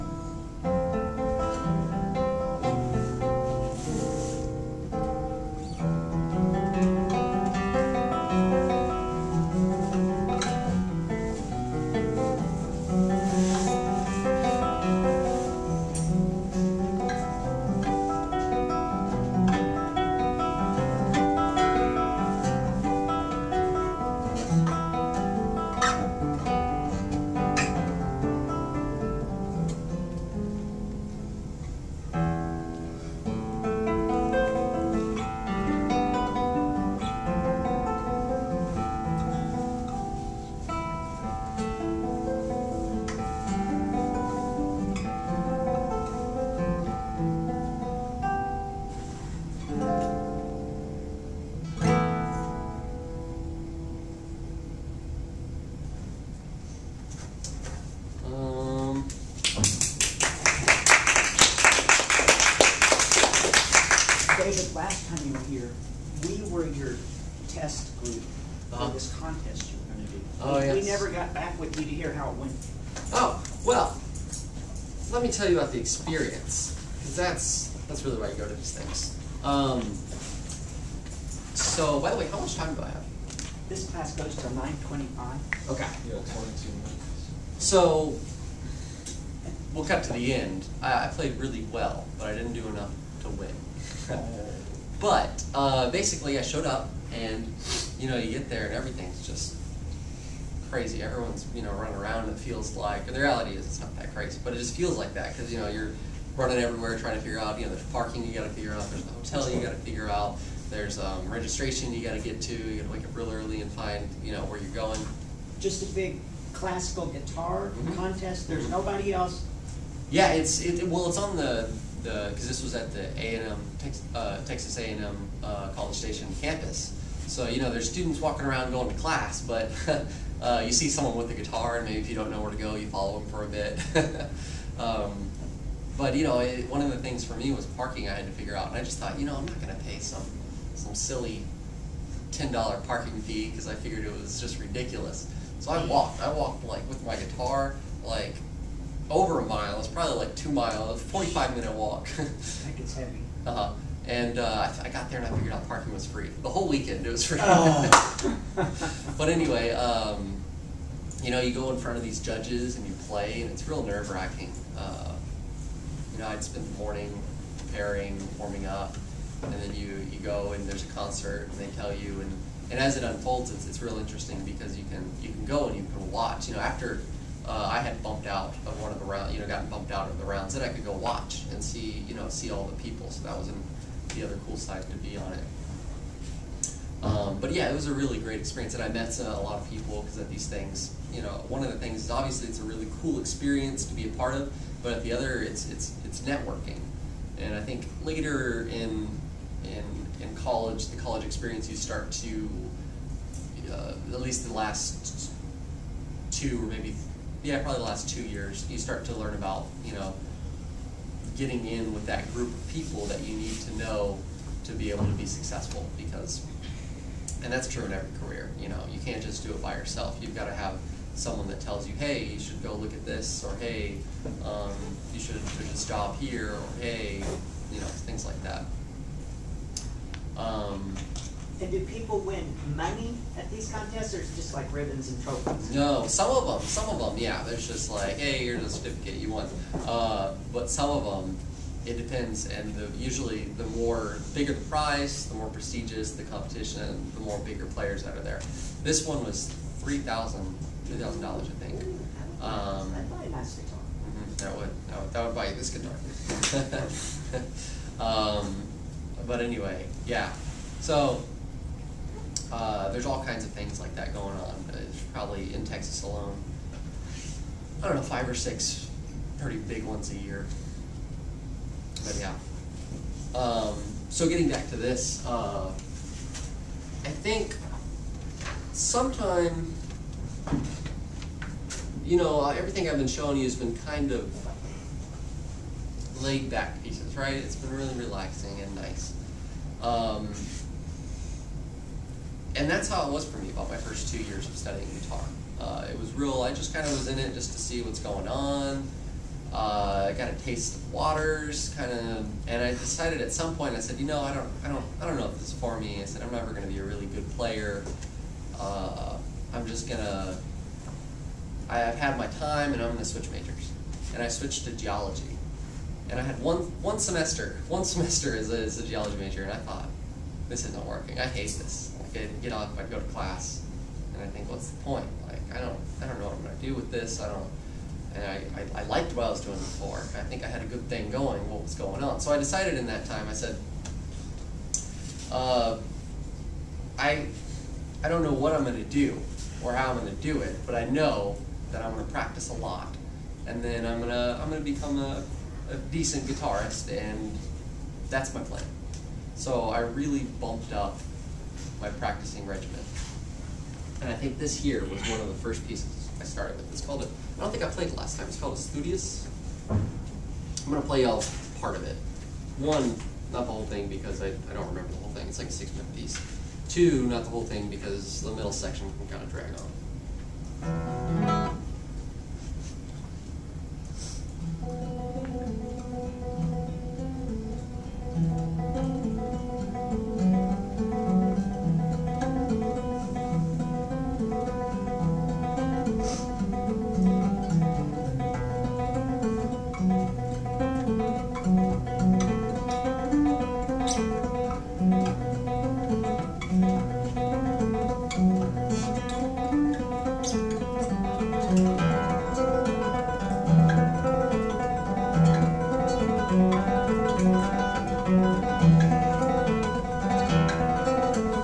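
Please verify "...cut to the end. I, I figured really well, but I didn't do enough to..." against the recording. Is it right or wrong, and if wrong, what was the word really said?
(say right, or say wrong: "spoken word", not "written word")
wrong: "played", not "figured".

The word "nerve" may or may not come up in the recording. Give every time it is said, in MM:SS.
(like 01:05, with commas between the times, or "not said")
02:43.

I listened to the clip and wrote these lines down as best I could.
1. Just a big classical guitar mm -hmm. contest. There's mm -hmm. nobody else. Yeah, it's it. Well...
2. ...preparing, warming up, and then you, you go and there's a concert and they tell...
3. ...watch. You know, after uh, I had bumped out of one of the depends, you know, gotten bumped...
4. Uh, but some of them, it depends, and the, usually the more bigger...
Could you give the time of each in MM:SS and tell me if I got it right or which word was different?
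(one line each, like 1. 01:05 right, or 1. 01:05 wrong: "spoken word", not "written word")
1. 01:55 right
2. 02:47 right
3. 02:56 wrong: "rounds", not "depends"
4. 03:59 right.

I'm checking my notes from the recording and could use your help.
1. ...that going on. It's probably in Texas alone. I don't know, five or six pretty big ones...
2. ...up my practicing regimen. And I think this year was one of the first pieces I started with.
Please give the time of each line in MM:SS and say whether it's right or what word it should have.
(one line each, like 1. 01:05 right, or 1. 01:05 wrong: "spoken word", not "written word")
1. 04:23 right
2. 05:50 right.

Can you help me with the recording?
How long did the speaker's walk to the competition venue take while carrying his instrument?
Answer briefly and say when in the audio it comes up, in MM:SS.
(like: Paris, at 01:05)
45 minutes, at 02:31.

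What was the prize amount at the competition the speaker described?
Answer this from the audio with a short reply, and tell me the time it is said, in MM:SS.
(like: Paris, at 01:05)
$3,000, at 04:10.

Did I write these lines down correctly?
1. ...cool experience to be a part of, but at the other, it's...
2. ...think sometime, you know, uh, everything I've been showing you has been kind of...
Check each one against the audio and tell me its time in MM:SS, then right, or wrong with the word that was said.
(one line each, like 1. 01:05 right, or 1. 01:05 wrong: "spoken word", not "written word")
1. 03:13 right
2. 04:37 right.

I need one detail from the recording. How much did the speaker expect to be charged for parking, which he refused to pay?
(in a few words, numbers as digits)
$10.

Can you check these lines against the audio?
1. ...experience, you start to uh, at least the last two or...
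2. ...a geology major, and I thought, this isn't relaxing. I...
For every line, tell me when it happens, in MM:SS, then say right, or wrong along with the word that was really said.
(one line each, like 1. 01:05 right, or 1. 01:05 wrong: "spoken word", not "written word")
1. 03:21 right
2. 05:18 wrong: "working", not "relaxing".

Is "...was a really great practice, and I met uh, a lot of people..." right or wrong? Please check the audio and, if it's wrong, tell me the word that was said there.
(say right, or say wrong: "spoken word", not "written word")
wrong: "experience", not "practice".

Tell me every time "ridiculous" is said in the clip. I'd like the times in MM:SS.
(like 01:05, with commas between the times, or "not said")
02:24.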